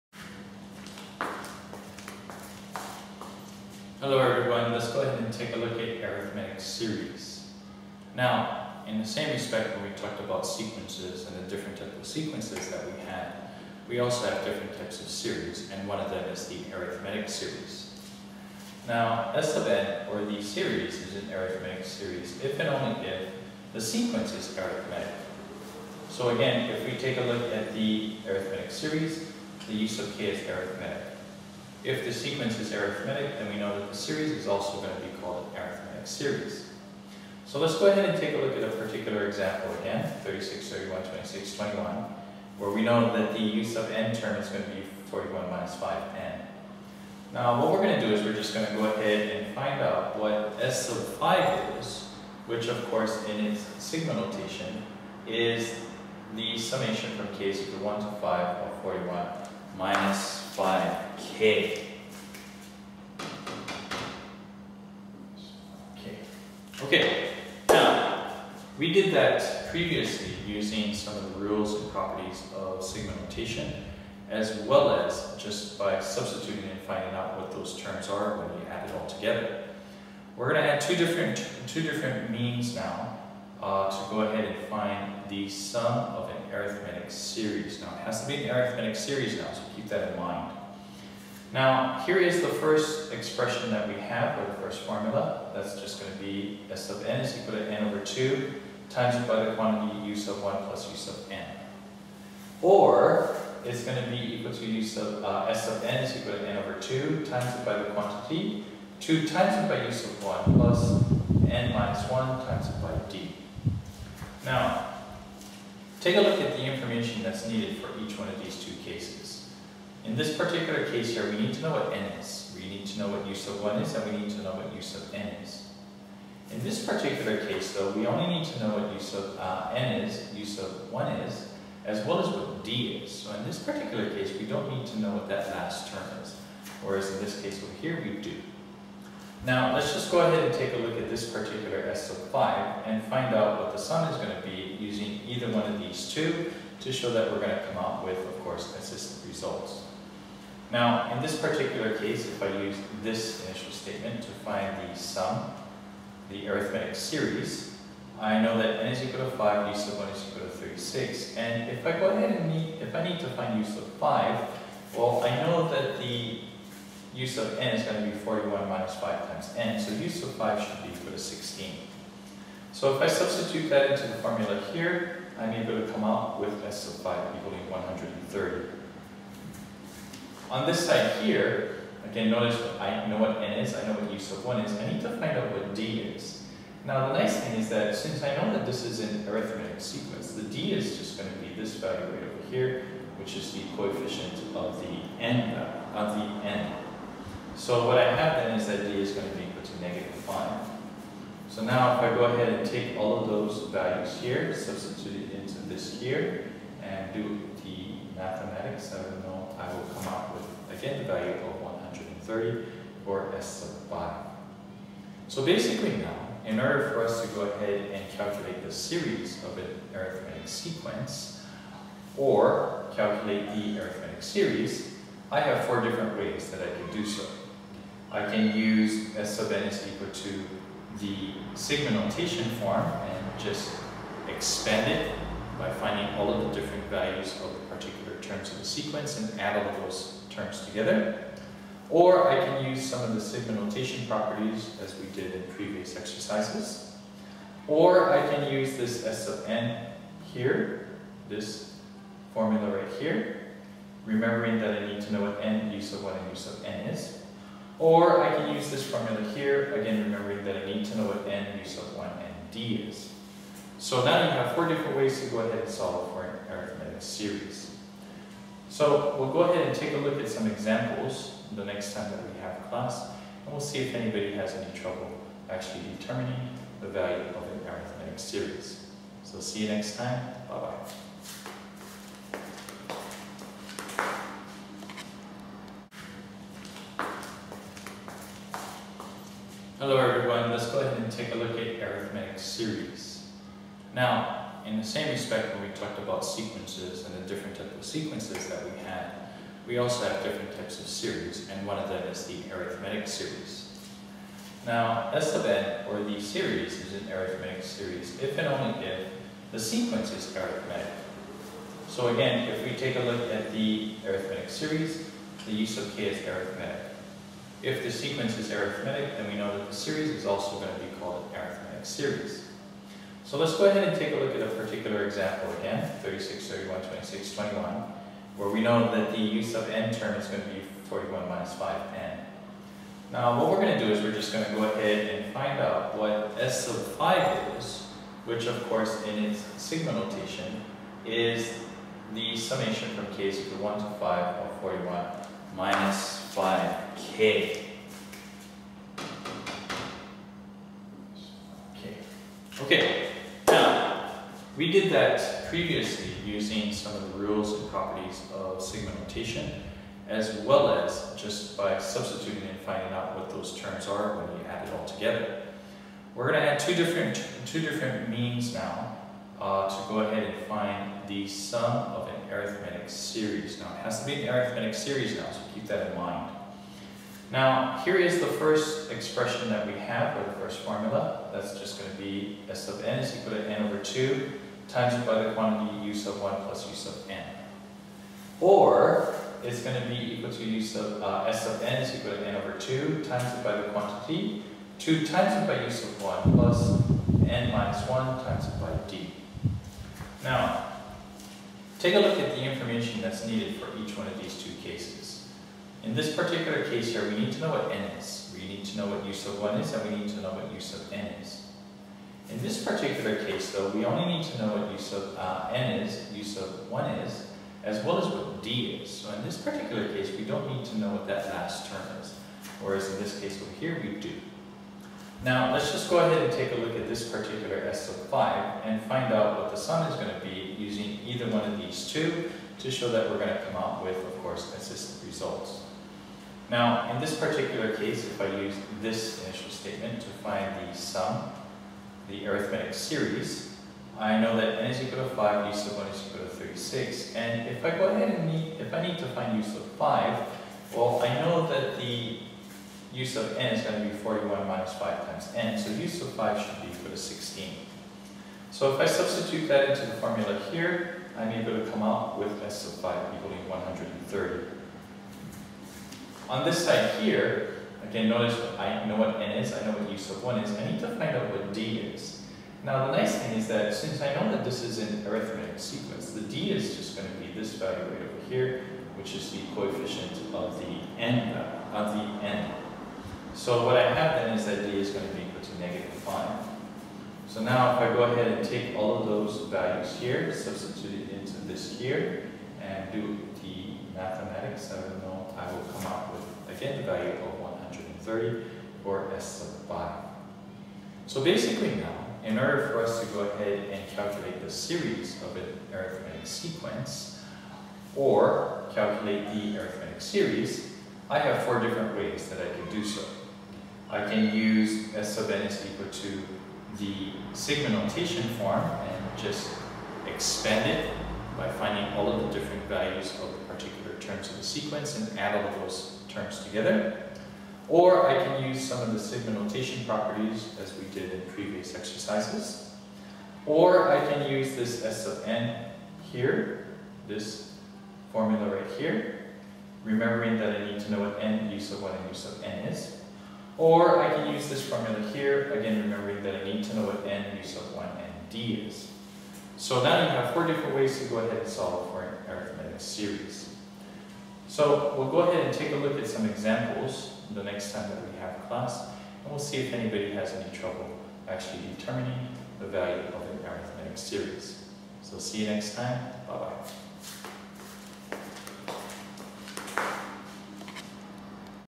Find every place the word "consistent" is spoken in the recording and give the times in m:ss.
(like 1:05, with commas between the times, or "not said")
2:28, 7:14.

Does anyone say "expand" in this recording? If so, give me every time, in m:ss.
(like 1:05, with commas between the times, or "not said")
3:54, 8:40.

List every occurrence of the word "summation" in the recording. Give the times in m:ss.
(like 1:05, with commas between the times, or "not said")
0:56, 5:42.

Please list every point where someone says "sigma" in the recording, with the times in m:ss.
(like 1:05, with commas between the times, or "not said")
0:53, 1:12, 3:51, 4:03, 5:39, 5:58, 8:37, 8:48.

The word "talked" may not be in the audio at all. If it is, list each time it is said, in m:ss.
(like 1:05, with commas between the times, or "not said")
0:09, 4:55.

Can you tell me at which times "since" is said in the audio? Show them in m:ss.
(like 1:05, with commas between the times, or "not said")
3:07, 7:53.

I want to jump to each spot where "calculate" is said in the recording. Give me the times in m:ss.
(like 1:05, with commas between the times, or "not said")
3:38, 3:42, 8:23, 8:28.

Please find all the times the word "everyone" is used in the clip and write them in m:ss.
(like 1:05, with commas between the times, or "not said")
0:04, 4:49.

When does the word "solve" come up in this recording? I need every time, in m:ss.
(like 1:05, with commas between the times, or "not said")
4:25, 9:11.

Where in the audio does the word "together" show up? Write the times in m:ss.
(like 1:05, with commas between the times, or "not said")
1:19, 4:00, 6:04, 8:46.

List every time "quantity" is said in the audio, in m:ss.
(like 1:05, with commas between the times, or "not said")
1:39, 1:47, 6:25, 6:33.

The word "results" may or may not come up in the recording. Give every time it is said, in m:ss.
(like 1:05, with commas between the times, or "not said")
2:29, 7:15.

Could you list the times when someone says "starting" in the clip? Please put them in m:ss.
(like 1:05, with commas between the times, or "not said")
not said.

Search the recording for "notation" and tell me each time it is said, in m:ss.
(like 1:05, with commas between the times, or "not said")
0:54, 1:13, 3:51, 4:03, 5:39, 5:58, 8:37, 8:49.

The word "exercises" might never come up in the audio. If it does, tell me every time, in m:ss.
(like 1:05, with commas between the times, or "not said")
4:05, 8:51.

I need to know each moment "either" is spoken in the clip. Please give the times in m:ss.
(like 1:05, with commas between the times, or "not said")
2:25, 7:11.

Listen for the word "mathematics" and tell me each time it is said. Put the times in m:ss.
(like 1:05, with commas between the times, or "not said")
3:28, 8:13.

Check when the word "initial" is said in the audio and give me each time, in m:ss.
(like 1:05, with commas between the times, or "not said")
2:33, 7:19.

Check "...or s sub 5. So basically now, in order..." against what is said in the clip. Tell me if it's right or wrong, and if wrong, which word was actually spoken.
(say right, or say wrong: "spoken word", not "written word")
right.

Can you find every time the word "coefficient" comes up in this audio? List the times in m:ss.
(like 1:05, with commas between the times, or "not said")
3:13, 7:59.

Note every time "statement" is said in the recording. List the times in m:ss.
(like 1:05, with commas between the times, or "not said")
2:33, 7:19.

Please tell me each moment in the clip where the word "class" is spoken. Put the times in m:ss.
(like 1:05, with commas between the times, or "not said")
4:32, 9:18.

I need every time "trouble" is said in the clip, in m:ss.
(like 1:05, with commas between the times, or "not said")
4:34, 9:20.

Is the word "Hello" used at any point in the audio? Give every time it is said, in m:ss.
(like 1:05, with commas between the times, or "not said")
0:04, 4:49.